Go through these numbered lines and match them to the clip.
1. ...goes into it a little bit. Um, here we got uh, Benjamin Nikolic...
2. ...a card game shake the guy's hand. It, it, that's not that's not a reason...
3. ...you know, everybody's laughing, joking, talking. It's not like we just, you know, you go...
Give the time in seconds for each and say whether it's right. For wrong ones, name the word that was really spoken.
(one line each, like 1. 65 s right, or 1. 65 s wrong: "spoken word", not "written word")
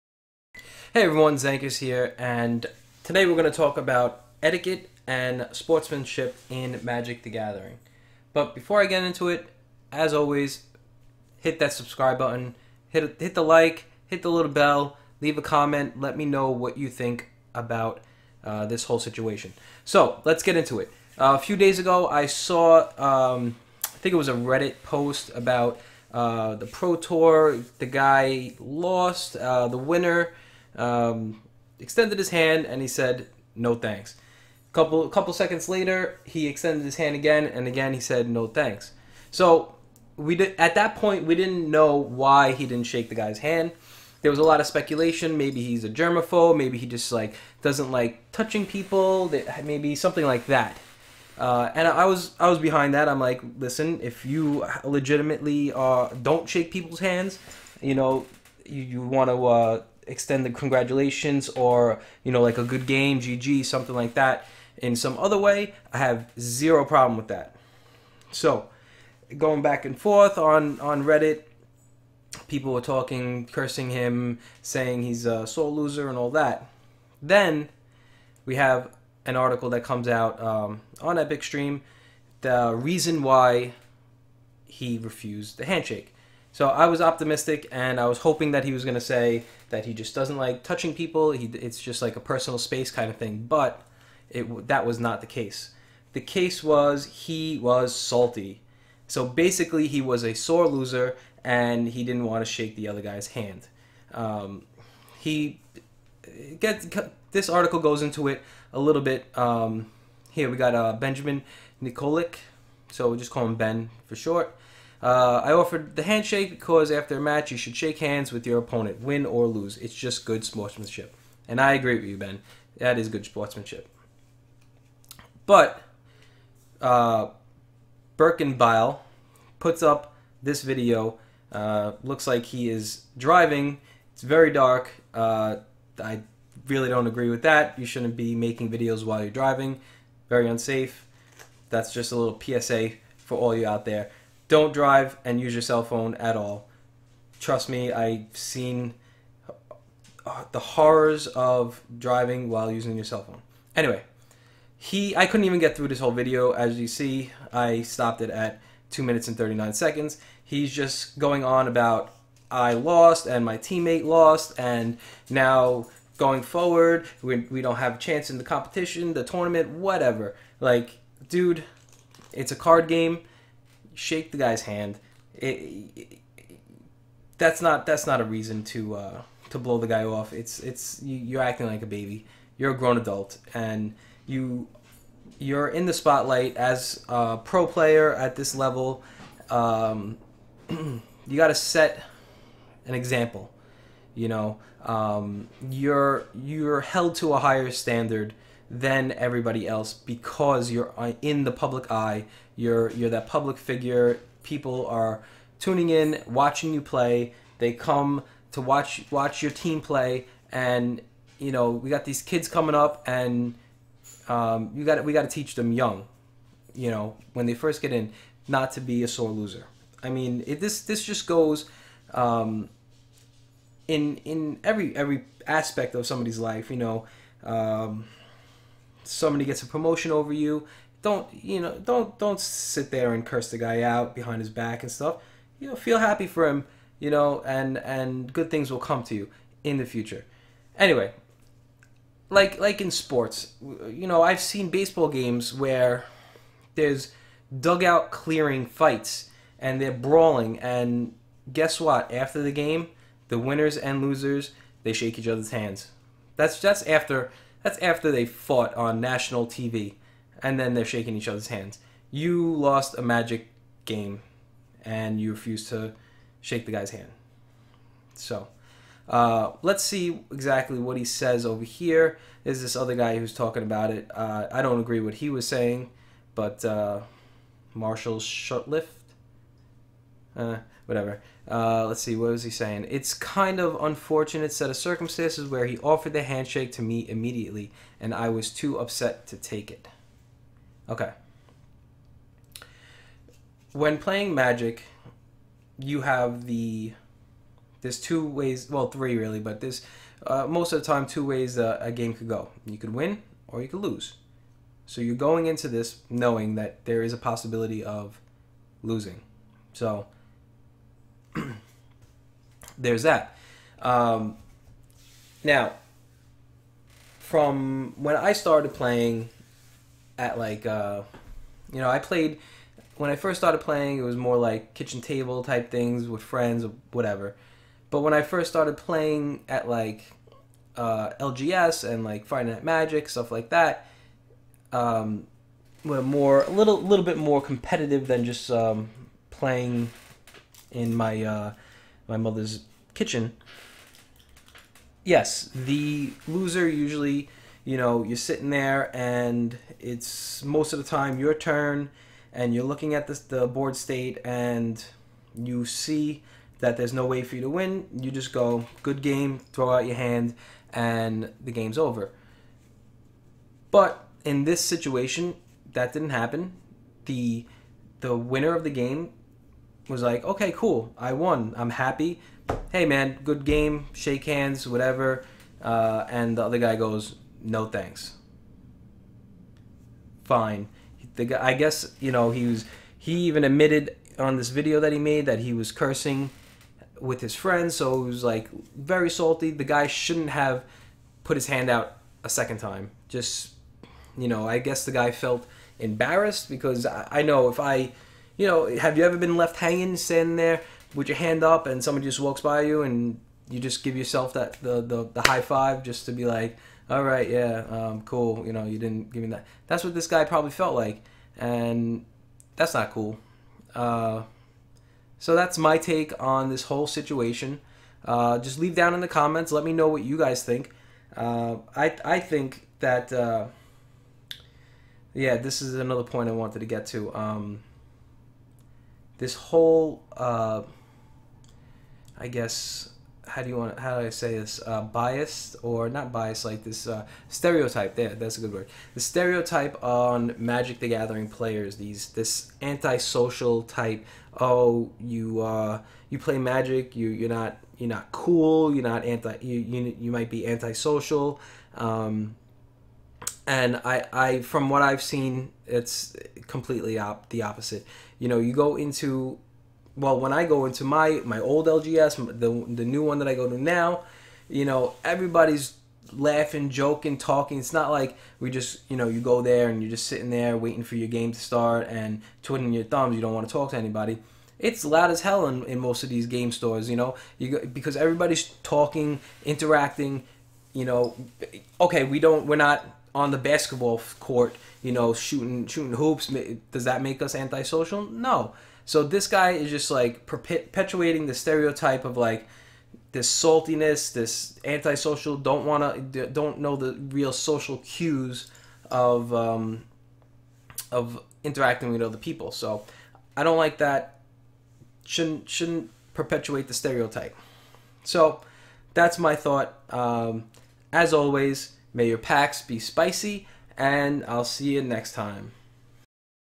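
1. 107 s right
2. 172 s right
3. 464 s right.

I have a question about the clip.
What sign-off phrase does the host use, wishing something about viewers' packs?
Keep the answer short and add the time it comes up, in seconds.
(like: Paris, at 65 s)
May your packs be spicy, at 511 s.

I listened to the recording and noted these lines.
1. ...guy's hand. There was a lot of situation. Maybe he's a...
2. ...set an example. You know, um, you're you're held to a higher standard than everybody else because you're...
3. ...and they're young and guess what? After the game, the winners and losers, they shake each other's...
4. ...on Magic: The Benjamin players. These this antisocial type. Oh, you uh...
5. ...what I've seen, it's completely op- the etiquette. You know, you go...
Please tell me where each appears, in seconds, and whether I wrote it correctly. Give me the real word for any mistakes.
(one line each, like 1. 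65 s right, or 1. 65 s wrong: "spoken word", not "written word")
1. 43 s wrong: "speculation", not "situation"
2. 191 s right
3. 249 s wrong: "brawling", not "young"
4. 439 s wrong: "Gathering", not "Benjamin"
5. 454 s wrong: "opposite", not "etiquette".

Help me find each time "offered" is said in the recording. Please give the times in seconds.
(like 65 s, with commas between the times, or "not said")
115 s, 285 s.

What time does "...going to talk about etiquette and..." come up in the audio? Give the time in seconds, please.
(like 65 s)
3 s.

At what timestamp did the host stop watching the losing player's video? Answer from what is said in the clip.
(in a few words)
2 minutes and 39 seconds.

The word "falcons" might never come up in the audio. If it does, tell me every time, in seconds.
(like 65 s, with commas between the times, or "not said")
not said.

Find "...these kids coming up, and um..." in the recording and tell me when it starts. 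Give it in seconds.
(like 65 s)
212 s.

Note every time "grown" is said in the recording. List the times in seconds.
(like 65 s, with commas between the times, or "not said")
182 s.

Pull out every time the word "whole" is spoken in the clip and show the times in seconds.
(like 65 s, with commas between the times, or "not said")
18 s, 155 s, 416 s, 429 s.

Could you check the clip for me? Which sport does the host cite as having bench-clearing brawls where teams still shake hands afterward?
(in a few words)
Baseball.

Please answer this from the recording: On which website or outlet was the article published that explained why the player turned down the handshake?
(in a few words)
Epic Stream.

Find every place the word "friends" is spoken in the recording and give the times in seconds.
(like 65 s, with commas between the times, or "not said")
326 s, 387 s.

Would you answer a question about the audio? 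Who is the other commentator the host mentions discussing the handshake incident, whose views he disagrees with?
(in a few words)
Marshall Sutcliffe.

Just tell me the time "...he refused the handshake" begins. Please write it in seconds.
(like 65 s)
84 s.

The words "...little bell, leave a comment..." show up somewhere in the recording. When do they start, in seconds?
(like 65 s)
14 s.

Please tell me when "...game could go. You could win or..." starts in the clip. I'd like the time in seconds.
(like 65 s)
301 s.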